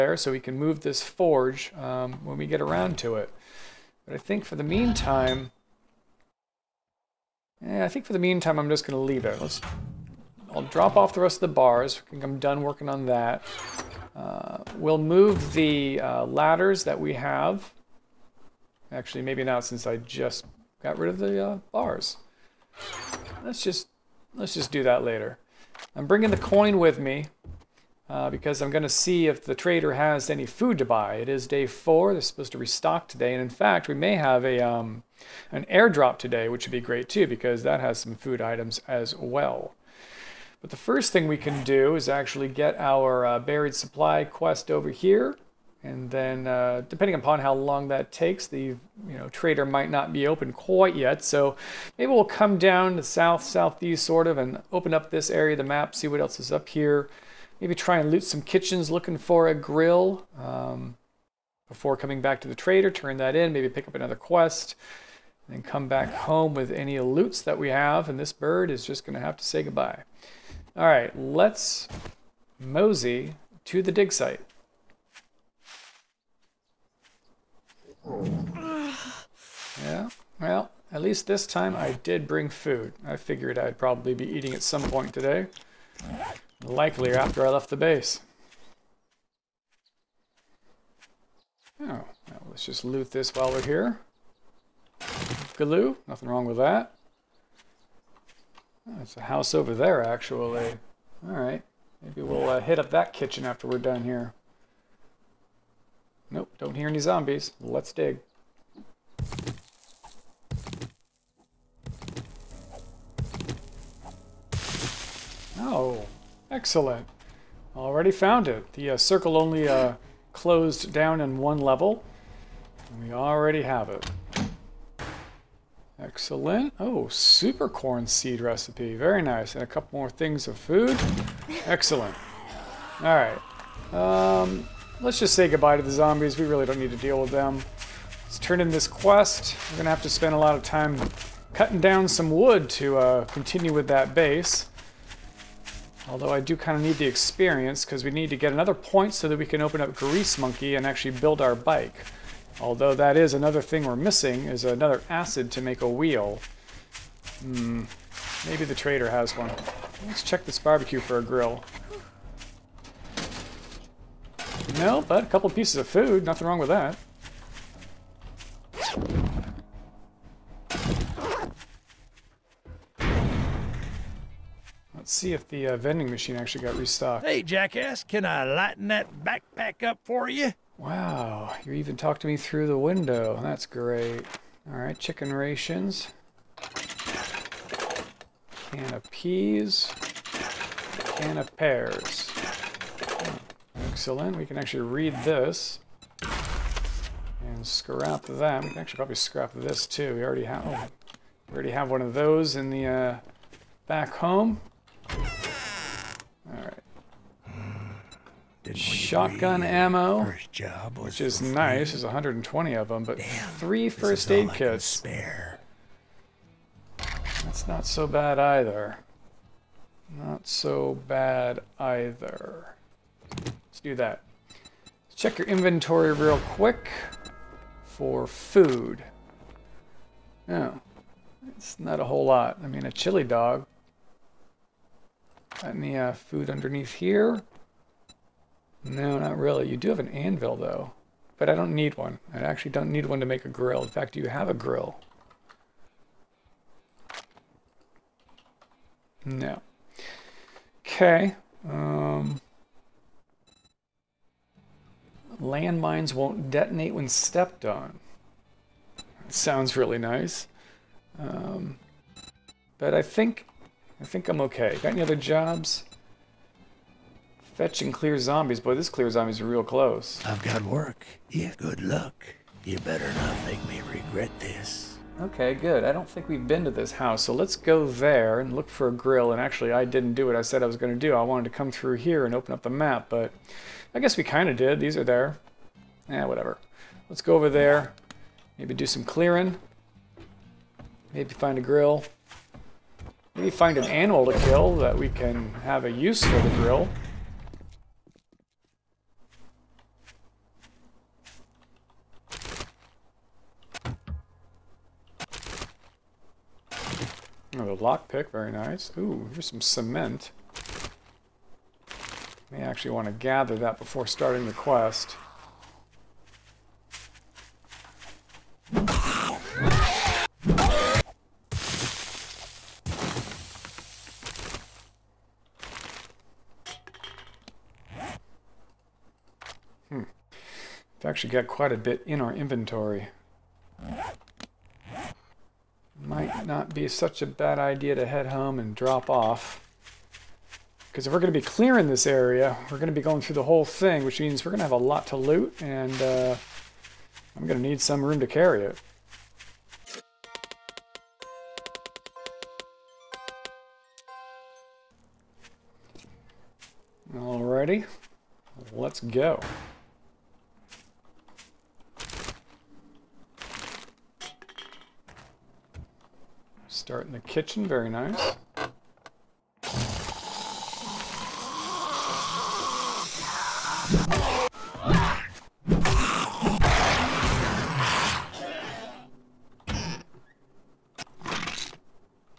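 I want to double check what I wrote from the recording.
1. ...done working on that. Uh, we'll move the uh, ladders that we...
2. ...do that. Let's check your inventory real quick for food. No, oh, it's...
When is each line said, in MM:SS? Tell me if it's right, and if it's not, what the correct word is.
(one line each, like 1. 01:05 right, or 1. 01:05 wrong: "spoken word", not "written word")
1. 00:12 right
2. 03:43 right.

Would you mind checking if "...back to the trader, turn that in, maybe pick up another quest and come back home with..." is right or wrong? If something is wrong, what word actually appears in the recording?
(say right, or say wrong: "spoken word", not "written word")
right.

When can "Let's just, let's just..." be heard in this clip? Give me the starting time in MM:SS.
00:23.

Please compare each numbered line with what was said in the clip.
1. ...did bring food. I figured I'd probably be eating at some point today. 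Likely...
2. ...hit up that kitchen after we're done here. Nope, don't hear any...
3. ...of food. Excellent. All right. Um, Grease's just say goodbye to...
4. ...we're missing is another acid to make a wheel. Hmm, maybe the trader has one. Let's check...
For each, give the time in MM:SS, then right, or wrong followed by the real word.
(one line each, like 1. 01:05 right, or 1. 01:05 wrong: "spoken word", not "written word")
1. 01:22 right
2. 01:42 right
3. 02:10 wrong: "Let", not "Grease"
4. 02:33 right.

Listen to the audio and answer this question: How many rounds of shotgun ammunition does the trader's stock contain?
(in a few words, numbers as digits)
120.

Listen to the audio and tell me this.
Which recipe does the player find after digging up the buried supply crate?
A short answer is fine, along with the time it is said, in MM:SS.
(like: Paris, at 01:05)
Super corn seed, at 02:07.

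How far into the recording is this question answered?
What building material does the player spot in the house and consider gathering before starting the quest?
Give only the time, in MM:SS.
05:09.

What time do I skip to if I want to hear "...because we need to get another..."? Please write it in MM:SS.
02:27.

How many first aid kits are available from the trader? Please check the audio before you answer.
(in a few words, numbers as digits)
3.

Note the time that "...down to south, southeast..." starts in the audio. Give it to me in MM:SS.
00:52.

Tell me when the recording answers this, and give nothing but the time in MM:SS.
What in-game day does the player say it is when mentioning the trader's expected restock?
00:31.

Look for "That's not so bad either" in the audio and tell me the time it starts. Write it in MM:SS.
03:37.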